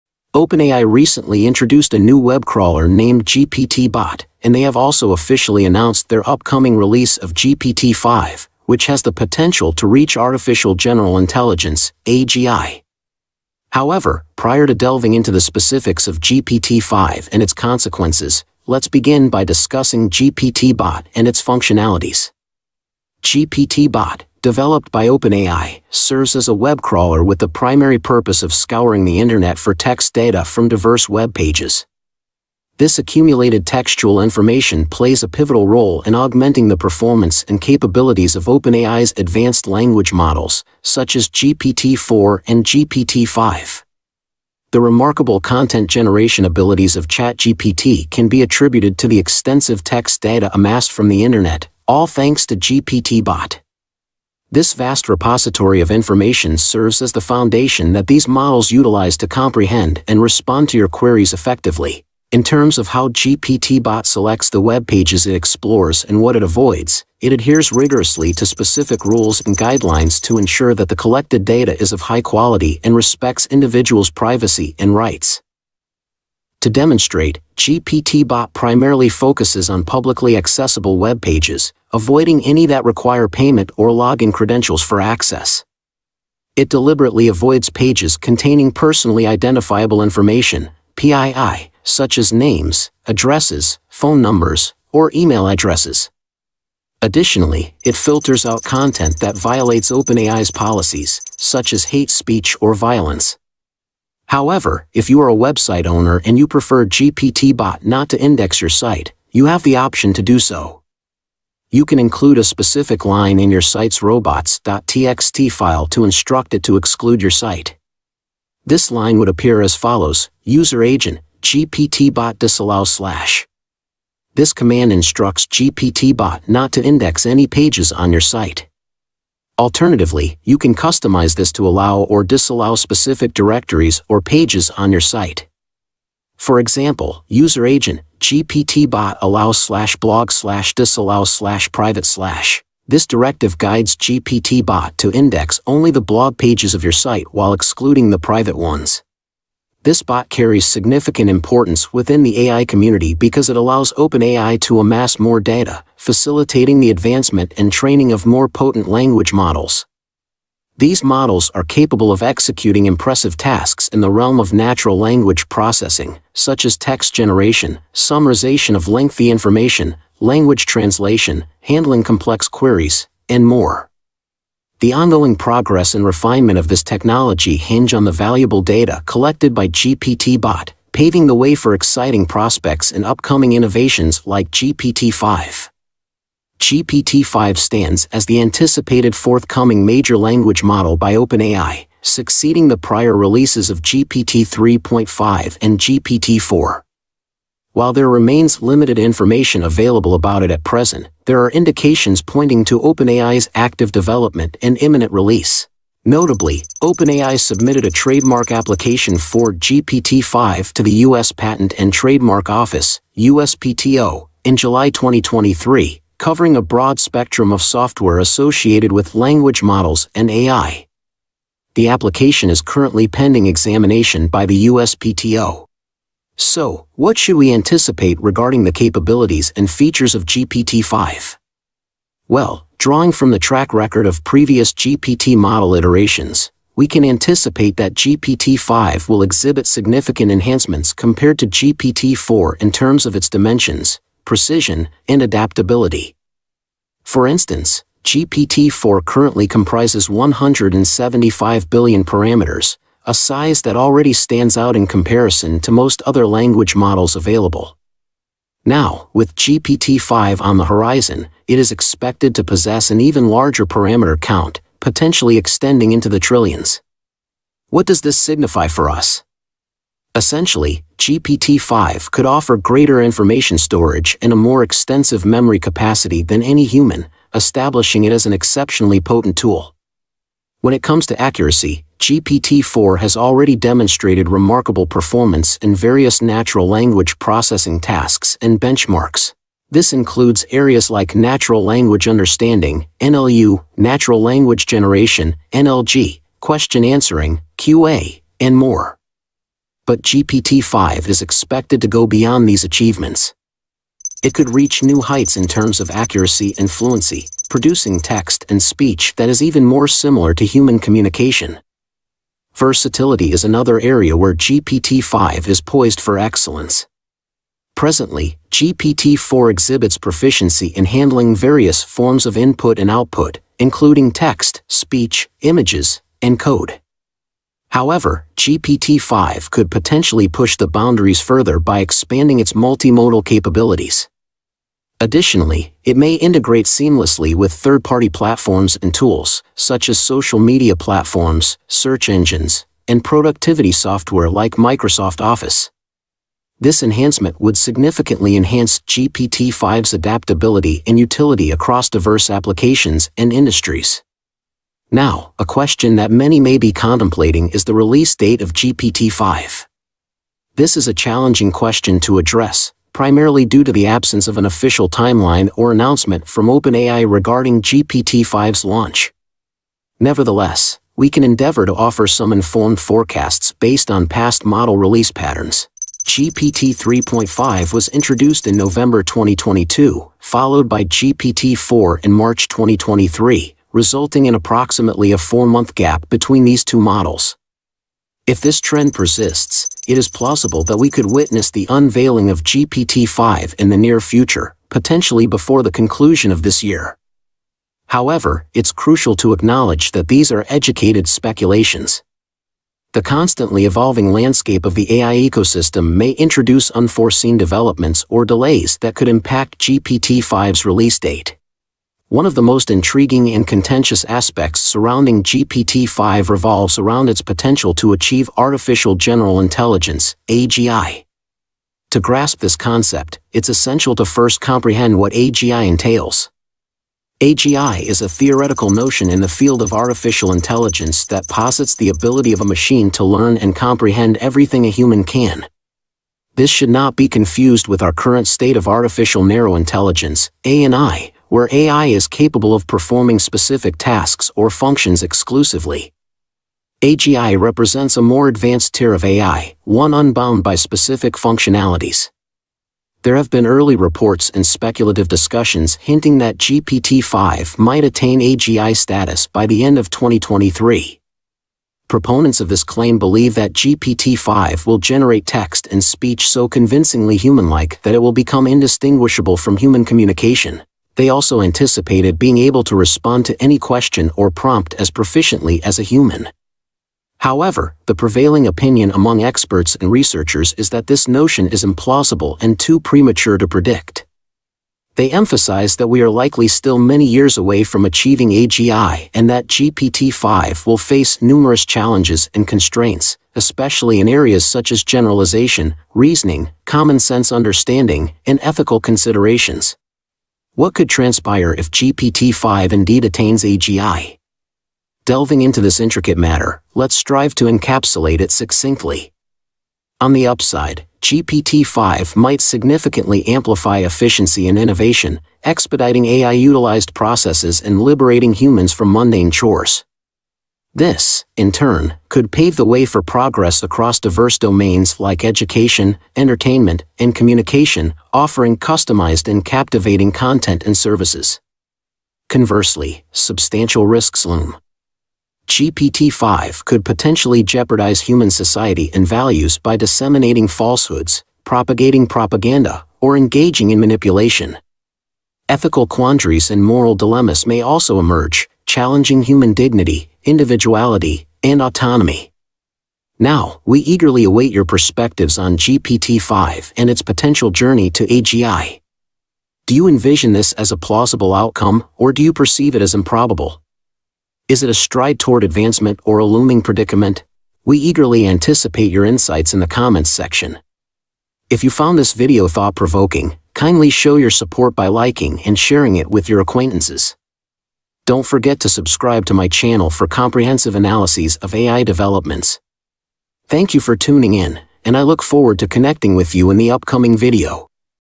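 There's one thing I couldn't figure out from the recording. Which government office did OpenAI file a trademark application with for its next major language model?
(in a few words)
U.S. Patent and Trademark Office.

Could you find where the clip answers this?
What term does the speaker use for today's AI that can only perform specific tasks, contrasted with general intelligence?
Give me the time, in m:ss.
7:18.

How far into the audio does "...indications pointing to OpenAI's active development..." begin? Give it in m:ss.
3:21.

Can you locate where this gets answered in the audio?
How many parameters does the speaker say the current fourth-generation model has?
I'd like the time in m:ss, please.
4:10.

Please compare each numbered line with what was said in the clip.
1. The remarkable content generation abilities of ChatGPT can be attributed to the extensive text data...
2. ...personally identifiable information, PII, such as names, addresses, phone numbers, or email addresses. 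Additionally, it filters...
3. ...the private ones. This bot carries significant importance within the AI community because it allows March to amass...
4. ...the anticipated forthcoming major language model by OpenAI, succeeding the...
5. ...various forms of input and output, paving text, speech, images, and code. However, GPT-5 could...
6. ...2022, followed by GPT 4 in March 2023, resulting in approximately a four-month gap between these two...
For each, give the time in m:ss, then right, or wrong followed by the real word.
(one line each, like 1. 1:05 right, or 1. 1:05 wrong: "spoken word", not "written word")
1. 0:44 right
2. 1:28 right
3. 2:28 wrong: "OpenAI", not "March"
4. 3:08 right
5. 5:21 wrong: "including", not "paving"
6. 6:19 right.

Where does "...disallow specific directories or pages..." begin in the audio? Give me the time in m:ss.
2:12.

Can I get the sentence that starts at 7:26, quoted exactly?
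AGI represents a more advanced tier of AI, one unbound by specific functionalities.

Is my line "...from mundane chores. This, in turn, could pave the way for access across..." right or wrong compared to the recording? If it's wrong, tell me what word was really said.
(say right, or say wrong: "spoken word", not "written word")
wrong: "progress", not "access".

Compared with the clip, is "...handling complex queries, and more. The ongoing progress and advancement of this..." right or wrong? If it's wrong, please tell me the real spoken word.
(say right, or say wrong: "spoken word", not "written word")
wrong: "refinement", not "advancement".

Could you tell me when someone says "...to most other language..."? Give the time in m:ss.
4:15.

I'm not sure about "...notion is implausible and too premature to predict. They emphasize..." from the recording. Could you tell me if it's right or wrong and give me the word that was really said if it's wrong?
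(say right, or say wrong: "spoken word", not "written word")
right.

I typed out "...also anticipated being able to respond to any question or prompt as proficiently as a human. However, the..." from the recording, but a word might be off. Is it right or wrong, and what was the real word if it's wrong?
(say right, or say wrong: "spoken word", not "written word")
right.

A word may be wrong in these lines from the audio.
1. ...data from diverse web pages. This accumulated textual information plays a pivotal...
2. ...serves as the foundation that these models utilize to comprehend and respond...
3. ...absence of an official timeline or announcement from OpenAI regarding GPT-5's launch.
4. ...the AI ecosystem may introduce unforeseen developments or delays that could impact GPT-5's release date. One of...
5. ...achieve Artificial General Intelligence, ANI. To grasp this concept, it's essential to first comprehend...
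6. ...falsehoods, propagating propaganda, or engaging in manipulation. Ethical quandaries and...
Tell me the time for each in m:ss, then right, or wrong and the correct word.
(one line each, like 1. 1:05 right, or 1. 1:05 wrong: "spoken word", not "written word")
1. 0:30 right
2. 0:56 right
3. 6:03 right
4. 6:44 right
5. 6:57 wrong: "AGI", not "ANI"
6. 9:00 right.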